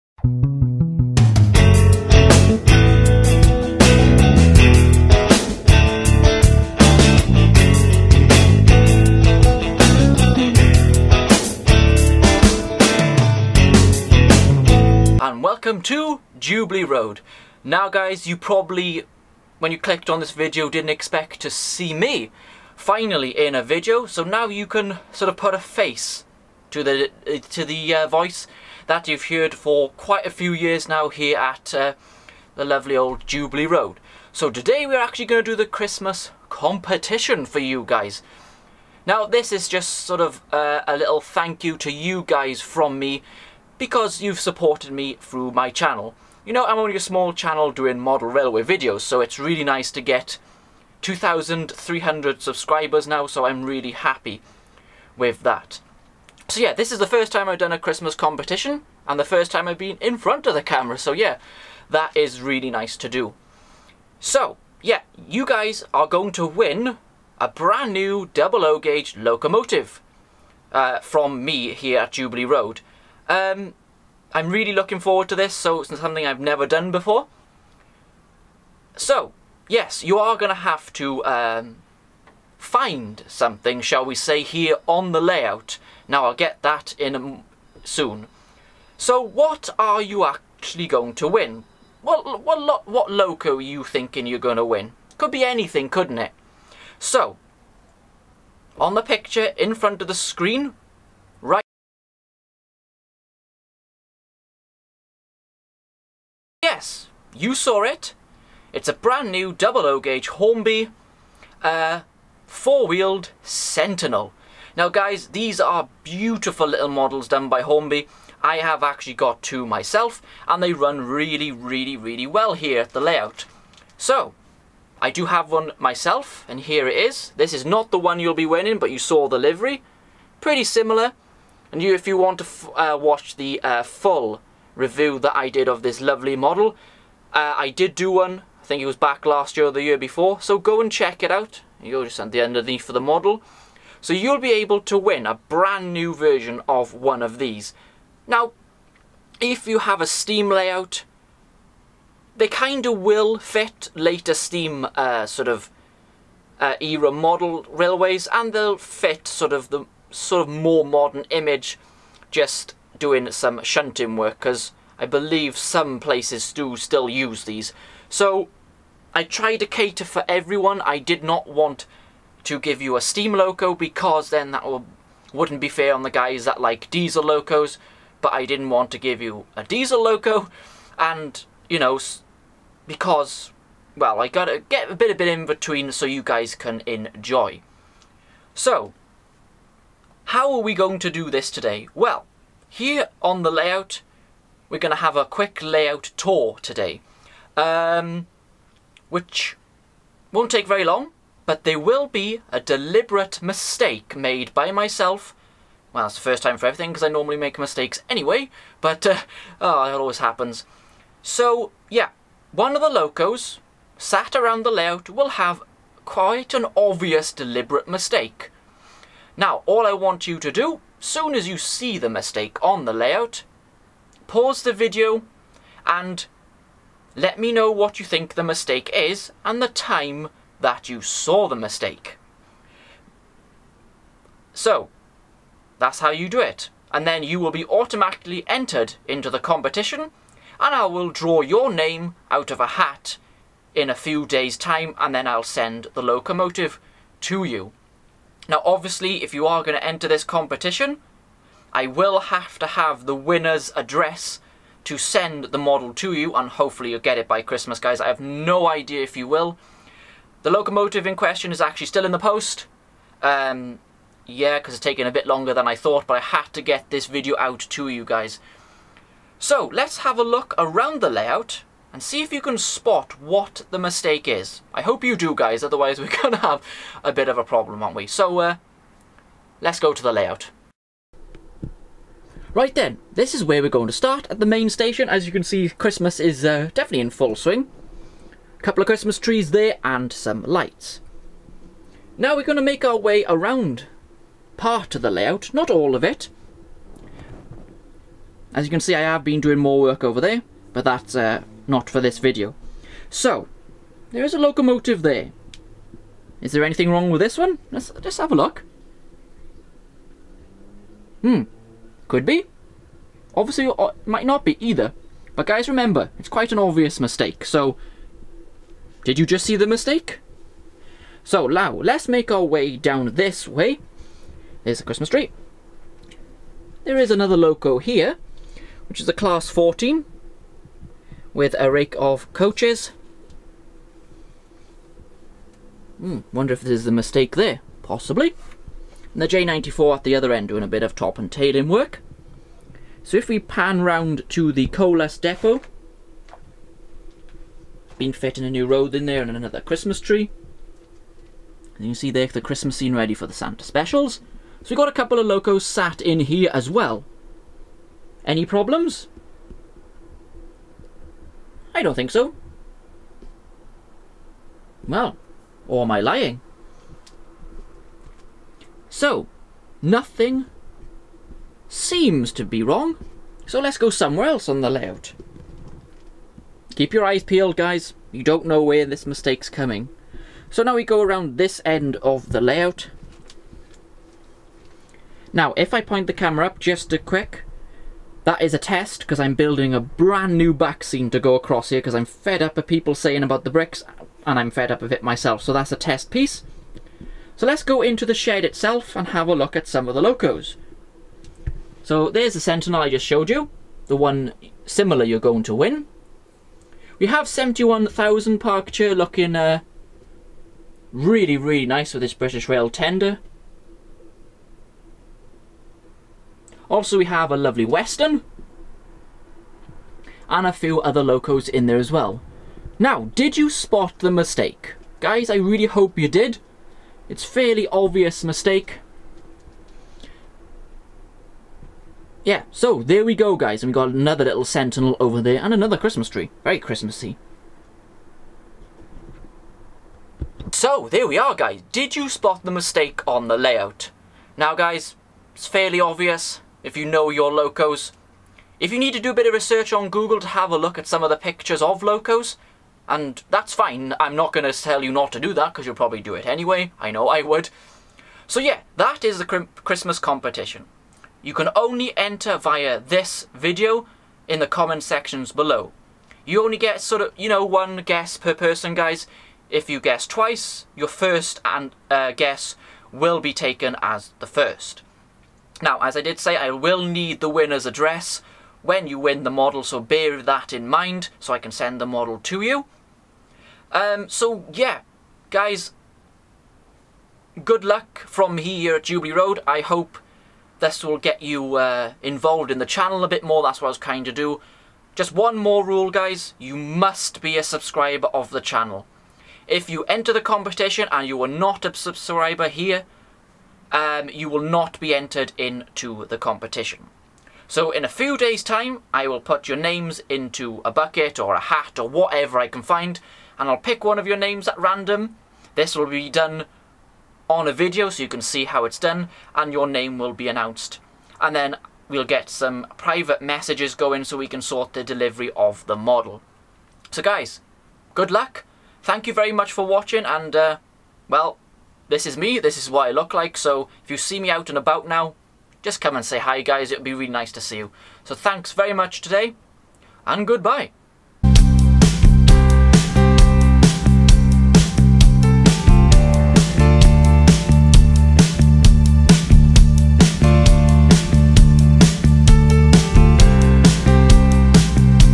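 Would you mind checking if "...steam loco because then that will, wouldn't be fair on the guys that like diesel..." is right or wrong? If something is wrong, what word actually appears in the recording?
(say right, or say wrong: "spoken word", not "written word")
right.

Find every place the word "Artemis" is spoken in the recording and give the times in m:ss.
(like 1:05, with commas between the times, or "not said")
not said.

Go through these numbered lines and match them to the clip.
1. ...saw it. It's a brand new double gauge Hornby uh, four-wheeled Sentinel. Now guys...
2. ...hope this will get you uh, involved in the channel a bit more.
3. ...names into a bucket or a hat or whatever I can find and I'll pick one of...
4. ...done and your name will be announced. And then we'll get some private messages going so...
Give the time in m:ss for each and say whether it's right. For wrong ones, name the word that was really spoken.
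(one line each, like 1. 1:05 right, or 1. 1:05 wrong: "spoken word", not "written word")
1. 1:47 right
2. 8:09 right
3. 8:29 right
4. 8:38 right.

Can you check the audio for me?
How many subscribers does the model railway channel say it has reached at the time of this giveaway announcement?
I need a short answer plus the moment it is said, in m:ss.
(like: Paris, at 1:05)
2,300, at 0:51.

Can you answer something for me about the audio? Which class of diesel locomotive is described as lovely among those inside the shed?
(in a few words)
Western.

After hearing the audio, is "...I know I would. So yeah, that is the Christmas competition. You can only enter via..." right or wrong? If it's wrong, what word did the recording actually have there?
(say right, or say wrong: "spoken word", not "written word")
right.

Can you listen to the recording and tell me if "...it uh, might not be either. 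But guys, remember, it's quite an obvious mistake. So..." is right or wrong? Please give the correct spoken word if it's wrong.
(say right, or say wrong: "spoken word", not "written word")
right.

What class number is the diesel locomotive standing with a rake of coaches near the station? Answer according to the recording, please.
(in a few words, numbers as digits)
Class 14.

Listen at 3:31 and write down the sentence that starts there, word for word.
So, yeah, one of the locos sat around the layout will have quite an obvious deliberate mistake.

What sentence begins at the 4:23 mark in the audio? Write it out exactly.
Um, yeah, because it's taken a bit longer than I thought, but I had to get this video out to you guys.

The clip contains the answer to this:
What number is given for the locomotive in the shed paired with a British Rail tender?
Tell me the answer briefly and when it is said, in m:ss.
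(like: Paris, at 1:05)
71000, at 6:47.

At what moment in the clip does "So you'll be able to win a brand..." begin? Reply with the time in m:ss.
2:24.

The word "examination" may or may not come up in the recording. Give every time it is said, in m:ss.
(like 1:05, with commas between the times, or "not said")
not said.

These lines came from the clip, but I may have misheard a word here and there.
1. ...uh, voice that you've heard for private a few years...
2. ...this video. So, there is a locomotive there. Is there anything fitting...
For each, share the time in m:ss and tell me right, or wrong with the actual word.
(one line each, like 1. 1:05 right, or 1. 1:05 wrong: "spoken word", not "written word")
1. 0:27 wrong: "quite", not "private"
2. 5:01 wrong: "wrong", not "fitting".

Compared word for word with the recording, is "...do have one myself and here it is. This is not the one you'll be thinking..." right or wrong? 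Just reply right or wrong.
wrong.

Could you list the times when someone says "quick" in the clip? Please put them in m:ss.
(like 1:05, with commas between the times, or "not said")
3:15, 6:26.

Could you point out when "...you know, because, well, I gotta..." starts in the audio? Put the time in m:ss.
3:01.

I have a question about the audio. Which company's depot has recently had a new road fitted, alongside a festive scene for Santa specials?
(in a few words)
Colas.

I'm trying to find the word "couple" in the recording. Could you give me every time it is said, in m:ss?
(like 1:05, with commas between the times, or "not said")
4:48, 5:54.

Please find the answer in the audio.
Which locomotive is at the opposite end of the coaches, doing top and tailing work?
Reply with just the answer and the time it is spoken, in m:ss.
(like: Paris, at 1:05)
J94, at 5:39.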